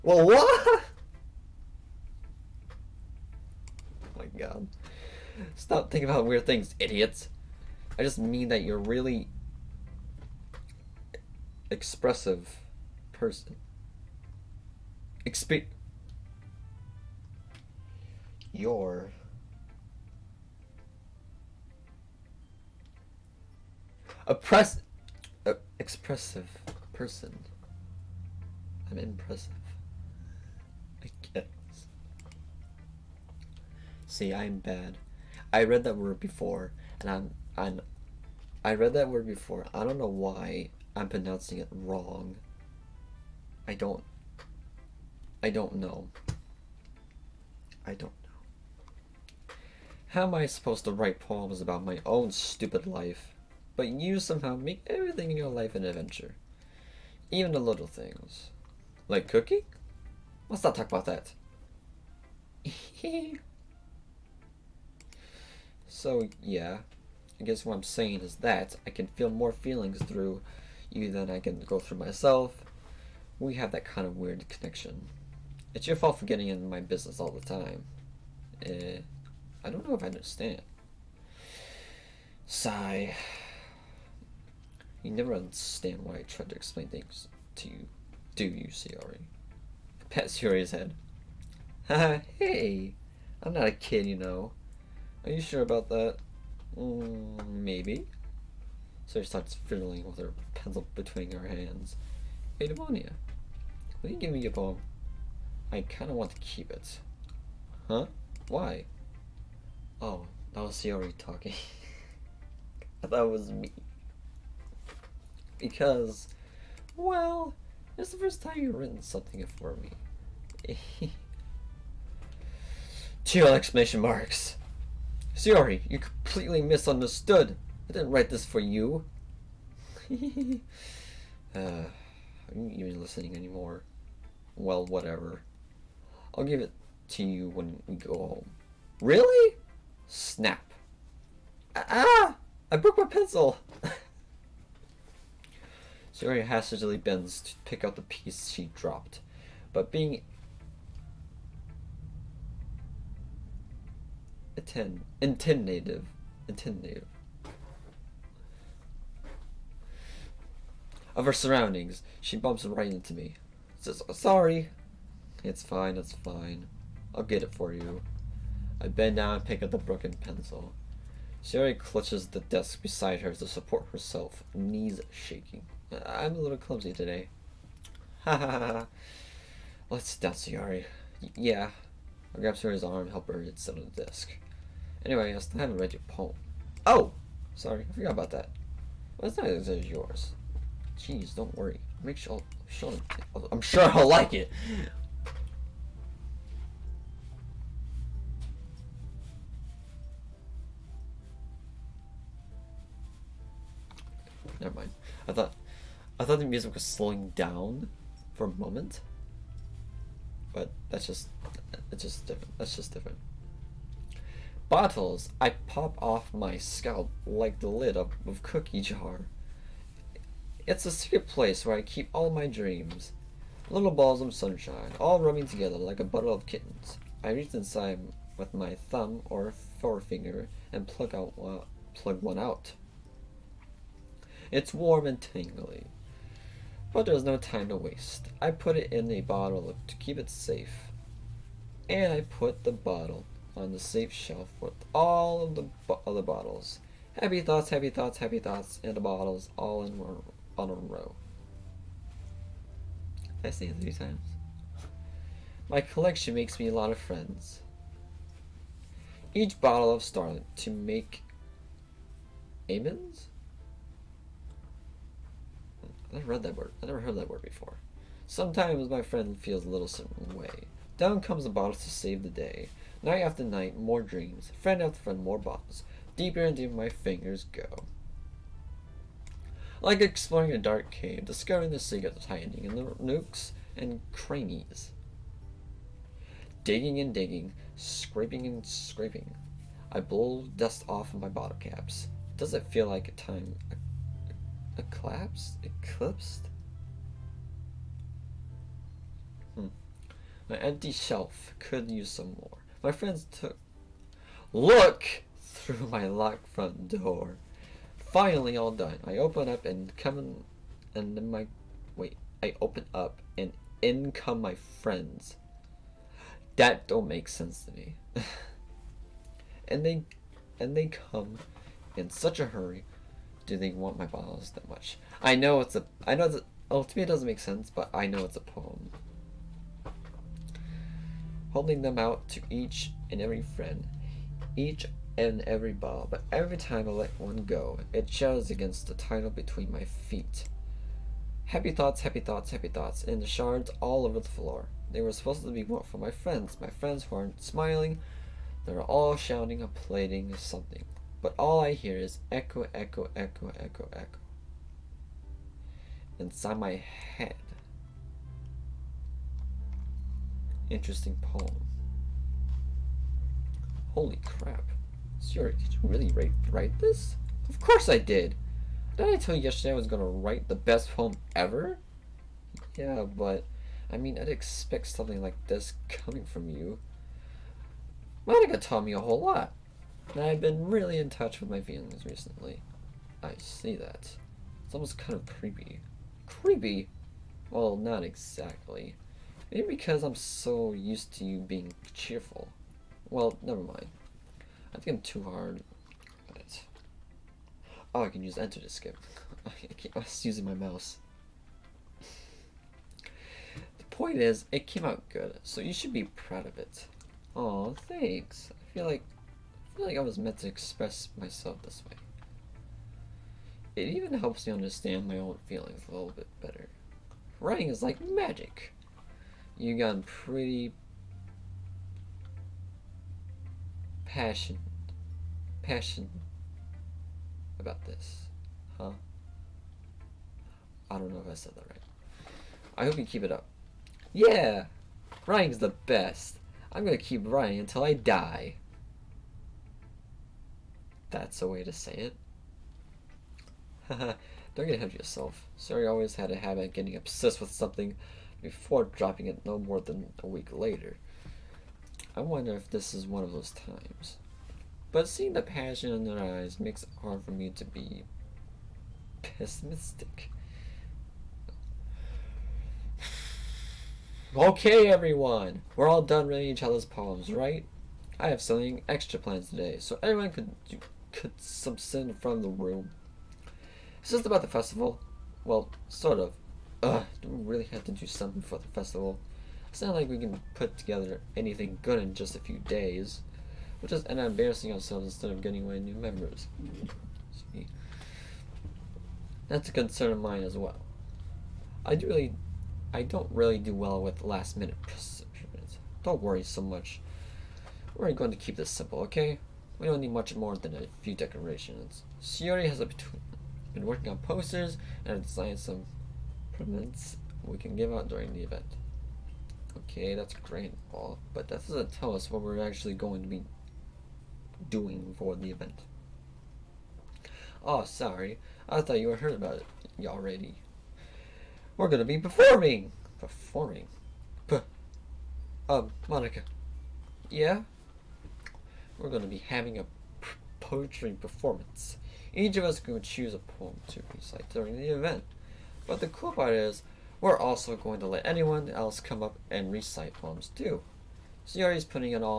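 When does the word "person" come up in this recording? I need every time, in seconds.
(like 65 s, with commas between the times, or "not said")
13 s, 26 s.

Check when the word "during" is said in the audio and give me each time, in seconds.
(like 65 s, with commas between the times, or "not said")
508 s, 534 s.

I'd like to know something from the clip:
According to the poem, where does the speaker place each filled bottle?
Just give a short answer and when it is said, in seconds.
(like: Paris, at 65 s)
the safe shelf, at 243 s.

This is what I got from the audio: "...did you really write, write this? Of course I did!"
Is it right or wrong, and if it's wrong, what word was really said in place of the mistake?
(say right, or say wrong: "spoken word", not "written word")
right.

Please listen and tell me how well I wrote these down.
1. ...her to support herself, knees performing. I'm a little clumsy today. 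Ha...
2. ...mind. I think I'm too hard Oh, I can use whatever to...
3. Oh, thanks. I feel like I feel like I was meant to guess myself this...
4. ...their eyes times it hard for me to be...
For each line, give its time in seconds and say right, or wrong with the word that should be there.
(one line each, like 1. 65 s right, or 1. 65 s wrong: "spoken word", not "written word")
1. 173 s wrong: "shaking", not "performing"
2. 393 s wrong: "enter", not "whatever"
3. 407 s wrong: "express", not "guess"
4. 456 s wrong: "makes", not "times".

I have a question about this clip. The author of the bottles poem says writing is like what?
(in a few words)
magic.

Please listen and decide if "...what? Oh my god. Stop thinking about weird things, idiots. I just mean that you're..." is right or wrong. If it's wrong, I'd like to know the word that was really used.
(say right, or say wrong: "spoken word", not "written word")
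right.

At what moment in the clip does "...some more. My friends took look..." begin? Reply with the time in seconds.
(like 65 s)
302 s.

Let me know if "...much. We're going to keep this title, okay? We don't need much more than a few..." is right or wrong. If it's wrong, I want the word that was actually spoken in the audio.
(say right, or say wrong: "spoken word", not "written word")
wrong: "simple", not "title".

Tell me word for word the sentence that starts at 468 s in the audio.
I have something extra planned today, so anyone could could subsist from the room.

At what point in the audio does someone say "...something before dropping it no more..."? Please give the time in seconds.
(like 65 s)
447 s.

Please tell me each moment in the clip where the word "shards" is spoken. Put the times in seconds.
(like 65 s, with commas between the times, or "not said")
343 s.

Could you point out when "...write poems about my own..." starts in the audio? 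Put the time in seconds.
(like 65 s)
50 s.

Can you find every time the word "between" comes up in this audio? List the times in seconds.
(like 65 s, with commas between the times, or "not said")
100 s, 339 s.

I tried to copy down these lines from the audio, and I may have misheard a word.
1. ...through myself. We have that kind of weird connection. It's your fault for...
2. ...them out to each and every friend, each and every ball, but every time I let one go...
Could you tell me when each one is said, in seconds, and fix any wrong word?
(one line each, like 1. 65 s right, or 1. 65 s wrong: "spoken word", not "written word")
1. 71 s right
2. 331 s right.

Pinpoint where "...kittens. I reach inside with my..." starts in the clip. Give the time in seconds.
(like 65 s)
226 s.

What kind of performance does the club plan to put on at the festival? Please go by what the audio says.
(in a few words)
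poetry performance.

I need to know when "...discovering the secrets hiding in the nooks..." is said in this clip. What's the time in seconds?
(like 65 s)
281 s.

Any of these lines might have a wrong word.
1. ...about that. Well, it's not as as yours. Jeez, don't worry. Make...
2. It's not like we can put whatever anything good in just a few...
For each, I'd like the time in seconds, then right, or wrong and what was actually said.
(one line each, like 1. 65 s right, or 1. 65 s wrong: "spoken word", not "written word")
1. 188 s right
2. 479 s wrong: "together", not "whatever".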